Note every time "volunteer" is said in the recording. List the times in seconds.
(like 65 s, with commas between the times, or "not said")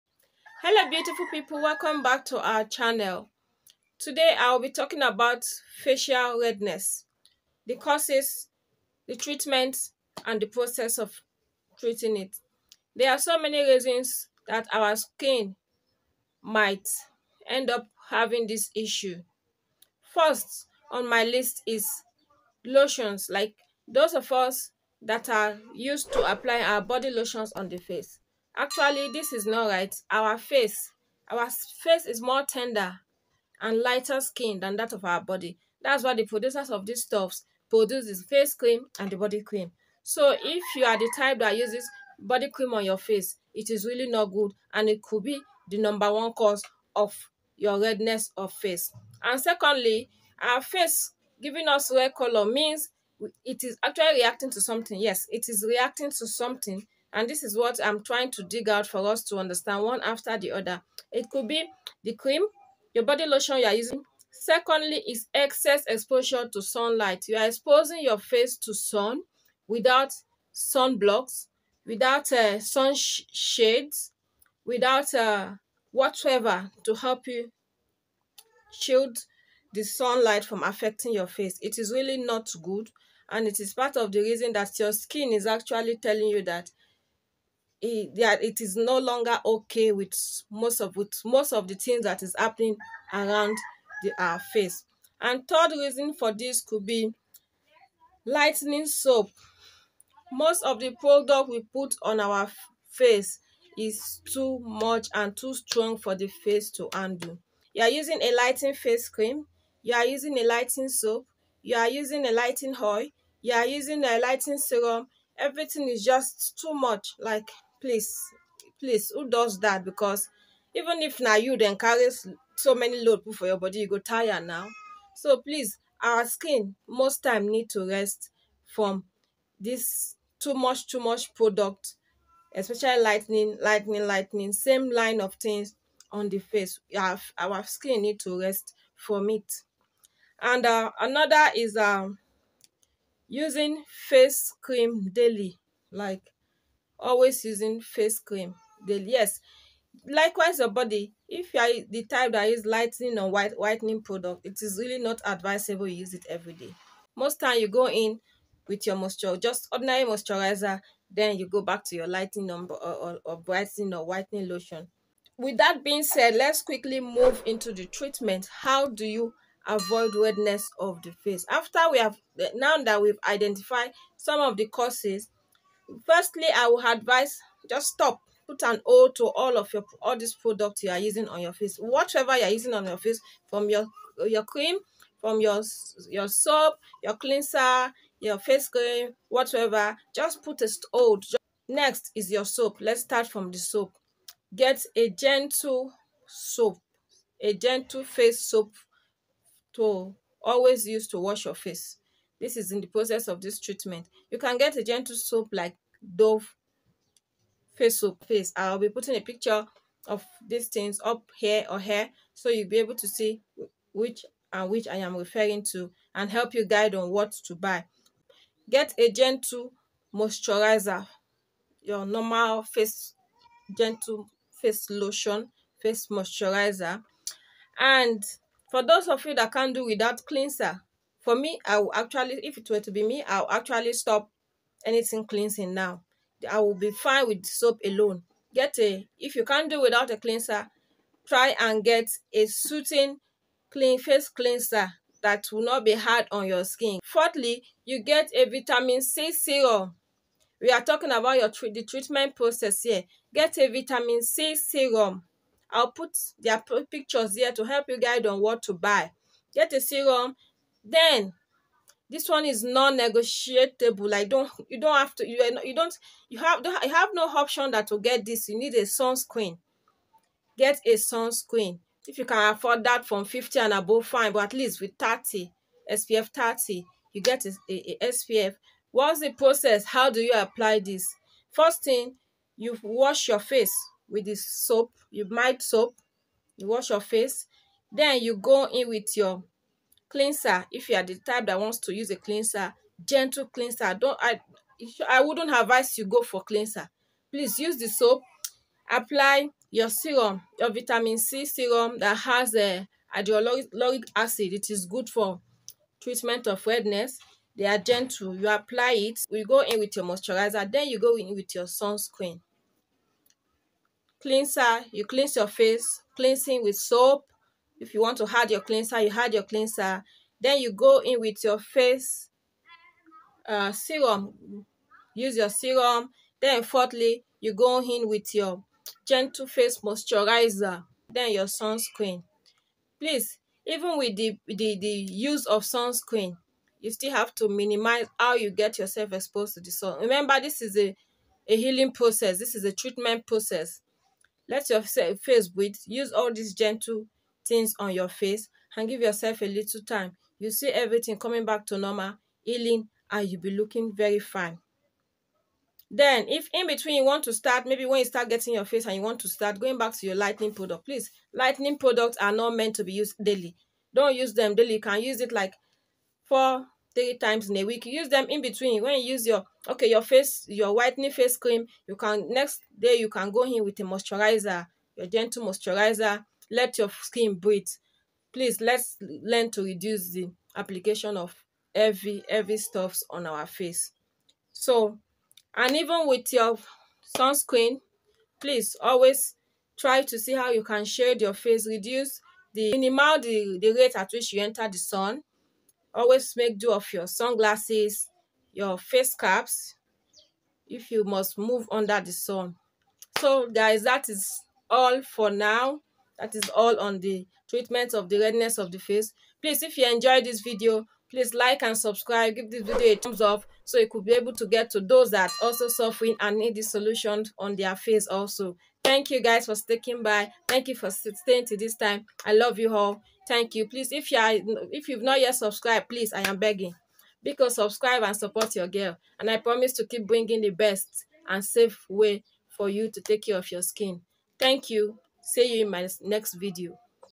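not said.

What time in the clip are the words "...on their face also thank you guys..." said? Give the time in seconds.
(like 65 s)
417 s.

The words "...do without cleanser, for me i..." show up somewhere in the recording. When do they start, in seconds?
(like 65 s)
229 s.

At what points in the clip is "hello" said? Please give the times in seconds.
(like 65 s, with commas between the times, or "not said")
0 s.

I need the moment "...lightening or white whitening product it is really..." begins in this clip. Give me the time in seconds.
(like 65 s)
152 s.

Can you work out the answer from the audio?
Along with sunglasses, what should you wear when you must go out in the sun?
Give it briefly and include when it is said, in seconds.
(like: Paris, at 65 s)
Face caps, at 398 s.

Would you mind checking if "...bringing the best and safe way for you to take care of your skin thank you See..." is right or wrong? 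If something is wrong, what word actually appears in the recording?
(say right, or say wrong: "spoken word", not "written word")
right.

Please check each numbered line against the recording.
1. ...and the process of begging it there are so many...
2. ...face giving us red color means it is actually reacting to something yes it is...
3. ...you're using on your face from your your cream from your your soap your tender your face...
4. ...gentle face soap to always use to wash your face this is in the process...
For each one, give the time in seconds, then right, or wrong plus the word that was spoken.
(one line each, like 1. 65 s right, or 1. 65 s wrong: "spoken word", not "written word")
1. 10 s wrong: "treating", not "begging"
2. 50 s right
3. 182 s wrong: "cleanser", not "tender"
4. 197 s right.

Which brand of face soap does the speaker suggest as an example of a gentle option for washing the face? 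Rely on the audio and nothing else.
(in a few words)
Dove.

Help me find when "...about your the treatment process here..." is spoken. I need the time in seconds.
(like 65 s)
251 s.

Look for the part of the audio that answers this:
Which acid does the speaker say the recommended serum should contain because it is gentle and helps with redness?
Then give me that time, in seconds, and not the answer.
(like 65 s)
303 s.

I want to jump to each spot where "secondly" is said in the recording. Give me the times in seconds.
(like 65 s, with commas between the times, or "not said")
49 s, 64 s.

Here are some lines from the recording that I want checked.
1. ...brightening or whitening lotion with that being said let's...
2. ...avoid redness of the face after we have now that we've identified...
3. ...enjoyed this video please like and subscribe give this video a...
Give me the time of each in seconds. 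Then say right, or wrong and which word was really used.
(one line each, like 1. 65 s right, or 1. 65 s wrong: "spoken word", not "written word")
1. 163 s right
2. 169 s right
3. 409 s right.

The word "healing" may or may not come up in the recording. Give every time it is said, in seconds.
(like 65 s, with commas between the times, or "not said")
341 s, 352 s.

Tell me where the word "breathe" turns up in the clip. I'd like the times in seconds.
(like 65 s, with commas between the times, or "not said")
345 s, 377 s.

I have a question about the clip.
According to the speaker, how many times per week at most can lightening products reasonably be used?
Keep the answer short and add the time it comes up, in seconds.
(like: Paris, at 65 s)
4, at 366 s.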